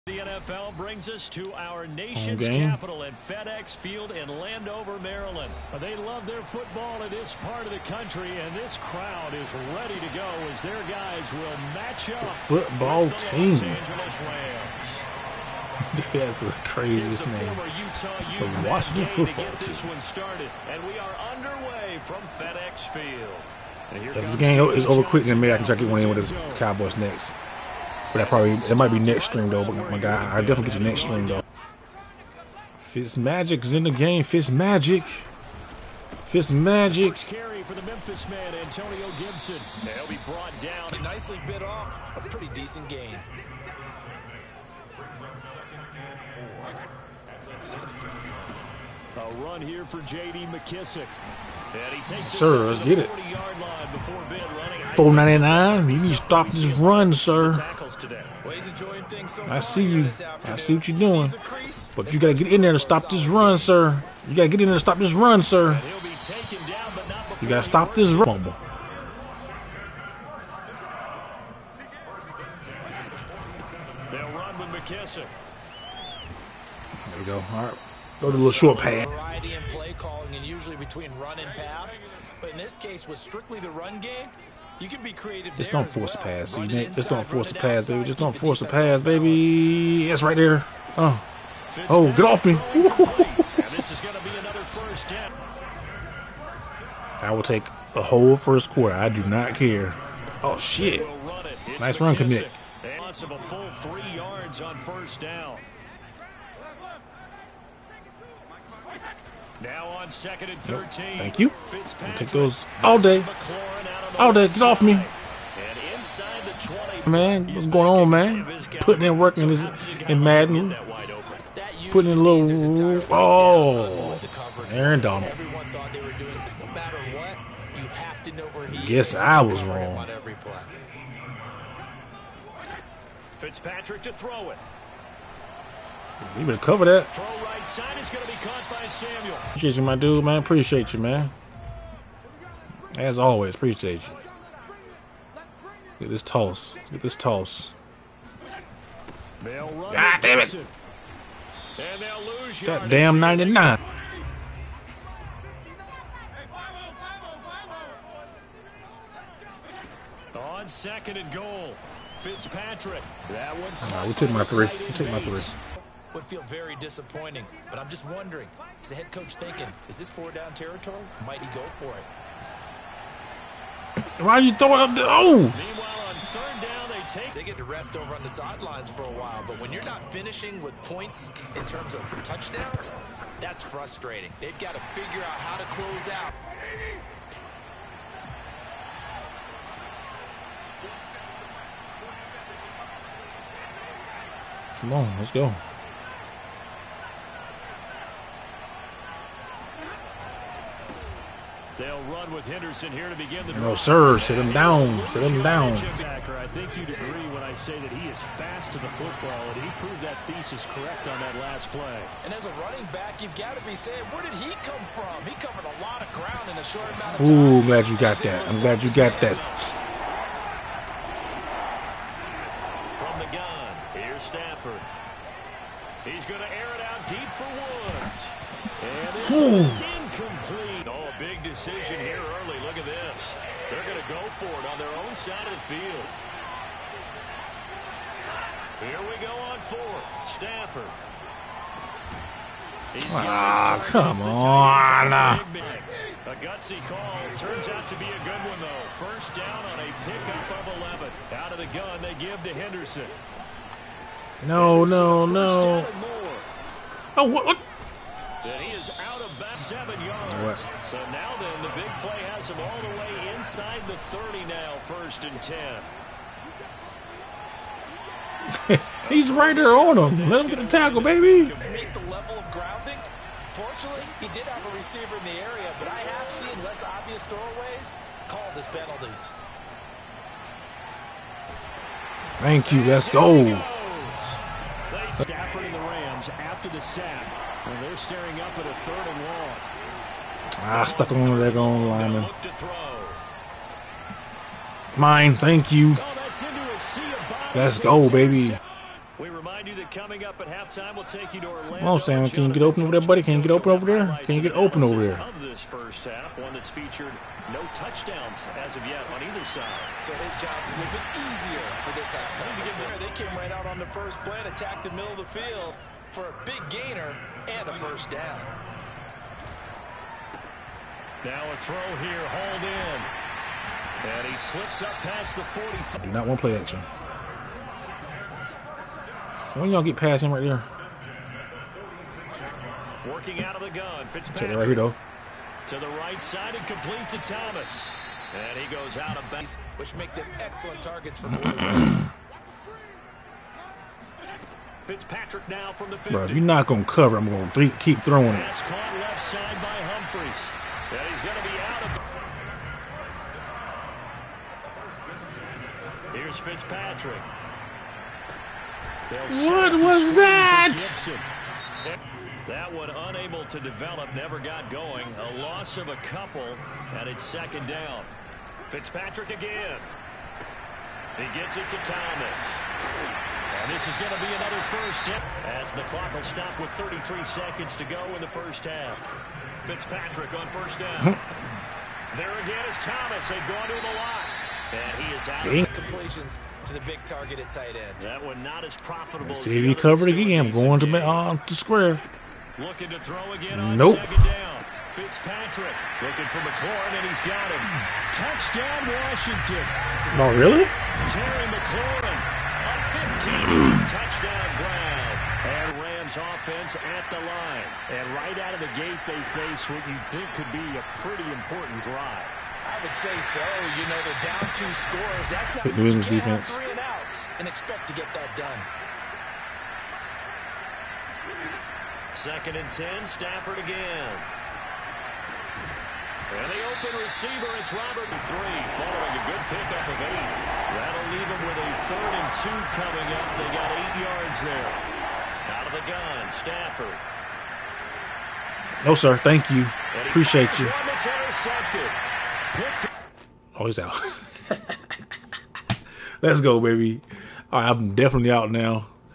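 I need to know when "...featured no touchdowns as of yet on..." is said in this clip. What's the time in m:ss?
5:06.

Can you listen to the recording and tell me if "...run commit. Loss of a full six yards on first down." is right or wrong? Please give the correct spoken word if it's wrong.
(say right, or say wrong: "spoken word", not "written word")
wrong: "three", not "six".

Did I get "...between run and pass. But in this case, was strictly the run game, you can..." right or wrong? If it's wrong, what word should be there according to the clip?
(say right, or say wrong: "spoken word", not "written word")
right.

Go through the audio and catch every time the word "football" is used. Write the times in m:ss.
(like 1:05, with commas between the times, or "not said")
0:06, 0:12, 0:19, 3:28.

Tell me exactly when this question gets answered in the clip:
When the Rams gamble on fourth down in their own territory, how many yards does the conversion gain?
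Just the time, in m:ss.
4:10.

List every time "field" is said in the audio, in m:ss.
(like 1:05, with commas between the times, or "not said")
0:03, 0:22, 3:55, 5:15.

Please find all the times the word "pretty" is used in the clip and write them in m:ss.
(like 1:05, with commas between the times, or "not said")
0:42, 6:50.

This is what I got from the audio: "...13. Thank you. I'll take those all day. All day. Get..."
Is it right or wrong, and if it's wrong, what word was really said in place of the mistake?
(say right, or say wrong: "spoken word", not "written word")
right.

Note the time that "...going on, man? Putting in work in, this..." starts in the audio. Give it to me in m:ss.
1:57.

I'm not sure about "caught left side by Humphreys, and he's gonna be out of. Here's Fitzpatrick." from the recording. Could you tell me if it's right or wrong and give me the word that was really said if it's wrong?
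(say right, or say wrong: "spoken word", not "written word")
right.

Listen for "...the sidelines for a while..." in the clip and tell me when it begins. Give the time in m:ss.
2:58.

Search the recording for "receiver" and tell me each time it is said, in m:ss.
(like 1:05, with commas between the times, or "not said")
4:34, 7:07.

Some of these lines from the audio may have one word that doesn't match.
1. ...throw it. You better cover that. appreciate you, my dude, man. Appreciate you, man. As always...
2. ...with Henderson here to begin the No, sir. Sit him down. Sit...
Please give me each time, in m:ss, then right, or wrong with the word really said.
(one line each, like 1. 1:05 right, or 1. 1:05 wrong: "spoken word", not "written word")
1. 2:14 right
2. 3:22 right.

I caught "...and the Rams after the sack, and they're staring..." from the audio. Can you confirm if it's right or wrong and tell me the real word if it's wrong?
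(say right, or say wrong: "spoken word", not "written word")
right.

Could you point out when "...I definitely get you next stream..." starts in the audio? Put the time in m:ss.
0:30.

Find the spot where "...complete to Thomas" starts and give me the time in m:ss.
5:36.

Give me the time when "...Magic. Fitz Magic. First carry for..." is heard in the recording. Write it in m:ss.
0:34.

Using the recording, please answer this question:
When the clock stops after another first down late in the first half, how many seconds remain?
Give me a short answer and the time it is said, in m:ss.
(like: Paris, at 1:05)
33, at 6:16.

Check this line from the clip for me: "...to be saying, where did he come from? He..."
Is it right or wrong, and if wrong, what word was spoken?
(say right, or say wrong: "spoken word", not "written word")
right.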